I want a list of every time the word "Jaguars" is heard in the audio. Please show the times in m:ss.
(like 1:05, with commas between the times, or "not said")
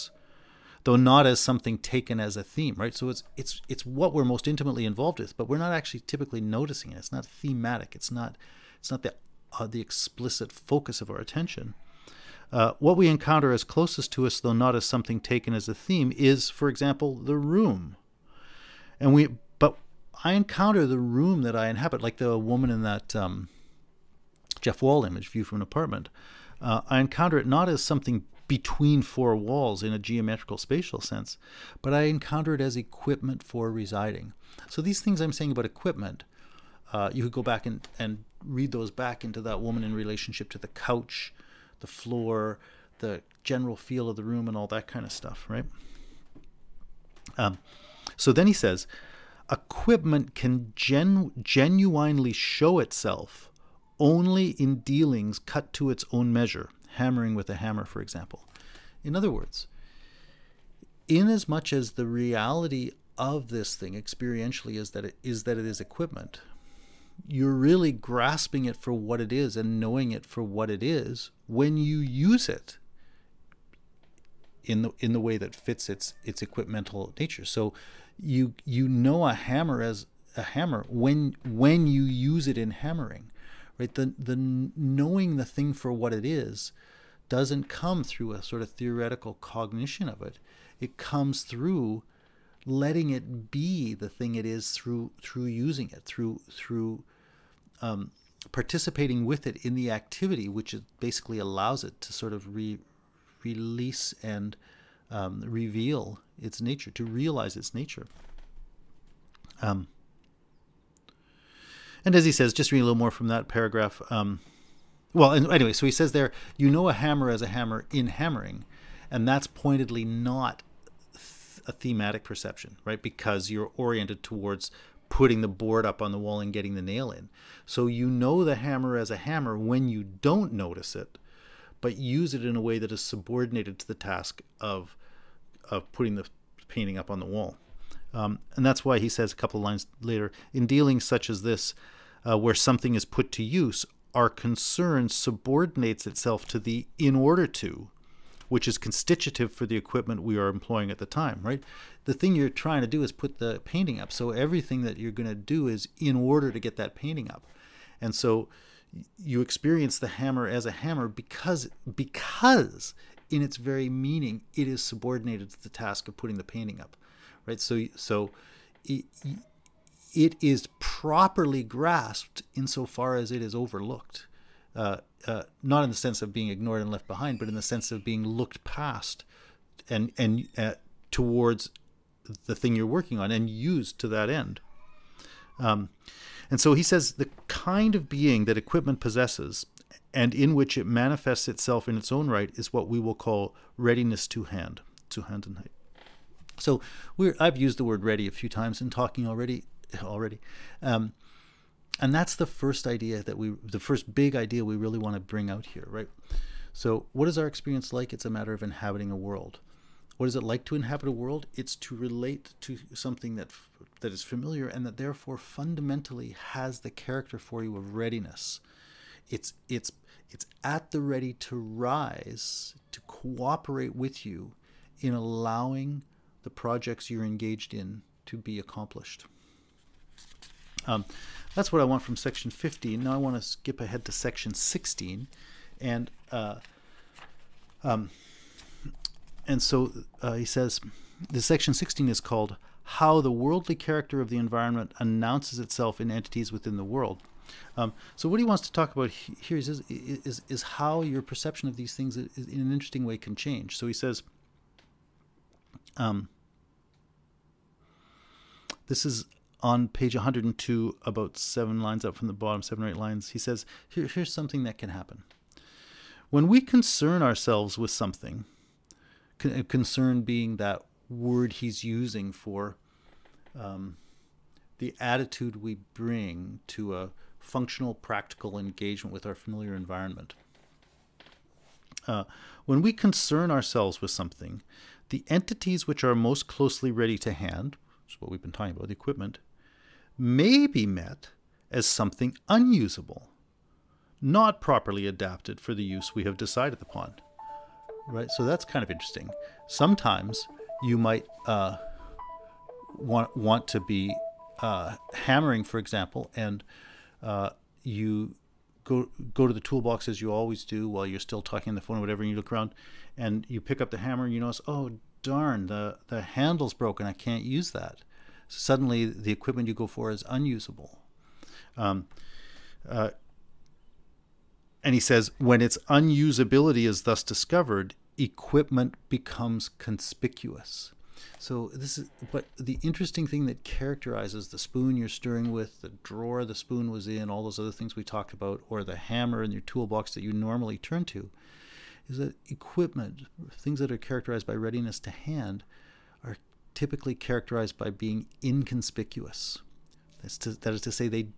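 not said.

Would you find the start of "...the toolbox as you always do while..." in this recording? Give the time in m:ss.
5:09.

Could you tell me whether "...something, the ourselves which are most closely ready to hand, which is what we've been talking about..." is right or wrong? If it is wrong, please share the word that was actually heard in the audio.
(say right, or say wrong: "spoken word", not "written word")
wrong: "entities", not "ourselves".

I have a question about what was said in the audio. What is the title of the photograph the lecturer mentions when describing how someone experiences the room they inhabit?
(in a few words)
View from an Apartment.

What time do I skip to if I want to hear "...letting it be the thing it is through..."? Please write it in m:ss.
1:32.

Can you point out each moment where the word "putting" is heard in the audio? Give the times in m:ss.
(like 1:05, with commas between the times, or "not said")
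2:05, 2:15, 2:46.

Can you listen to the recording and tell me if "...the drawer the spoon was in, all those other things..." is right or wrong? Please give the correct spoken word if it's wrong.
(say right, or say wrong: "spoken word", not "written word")
right.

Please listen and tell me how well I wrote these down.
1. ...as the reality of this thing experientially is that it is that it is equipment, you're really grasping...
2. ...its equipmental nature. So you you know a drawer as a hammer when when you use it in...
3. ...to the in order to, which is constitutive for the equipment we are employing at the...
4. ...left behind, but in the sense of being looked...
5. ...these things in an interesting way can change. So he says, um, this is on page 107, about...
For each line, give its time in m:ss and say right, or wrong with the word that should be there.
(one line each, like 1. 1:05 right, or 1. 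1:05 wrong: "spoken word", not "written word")
1. 1:01 right
2. 1:16 wrong: "hammer", not "drawer"
3. 2:26 right
4. 2:56 right
5. 4:11 wrong: "102", not "107".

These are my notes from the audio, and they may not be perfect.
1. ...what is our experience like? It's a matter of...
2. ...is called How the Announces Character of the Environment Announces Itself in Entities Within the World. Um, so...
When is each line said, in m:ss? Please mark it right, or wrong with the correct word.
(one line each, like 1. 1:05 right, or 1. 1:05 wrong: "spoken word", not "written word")
1. 3:27 right
2. 4:02 wrong: "Worldly", not "Announces".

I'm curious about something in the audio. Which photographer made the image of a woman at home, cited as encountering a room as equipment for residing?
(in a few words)
Jeff Wall.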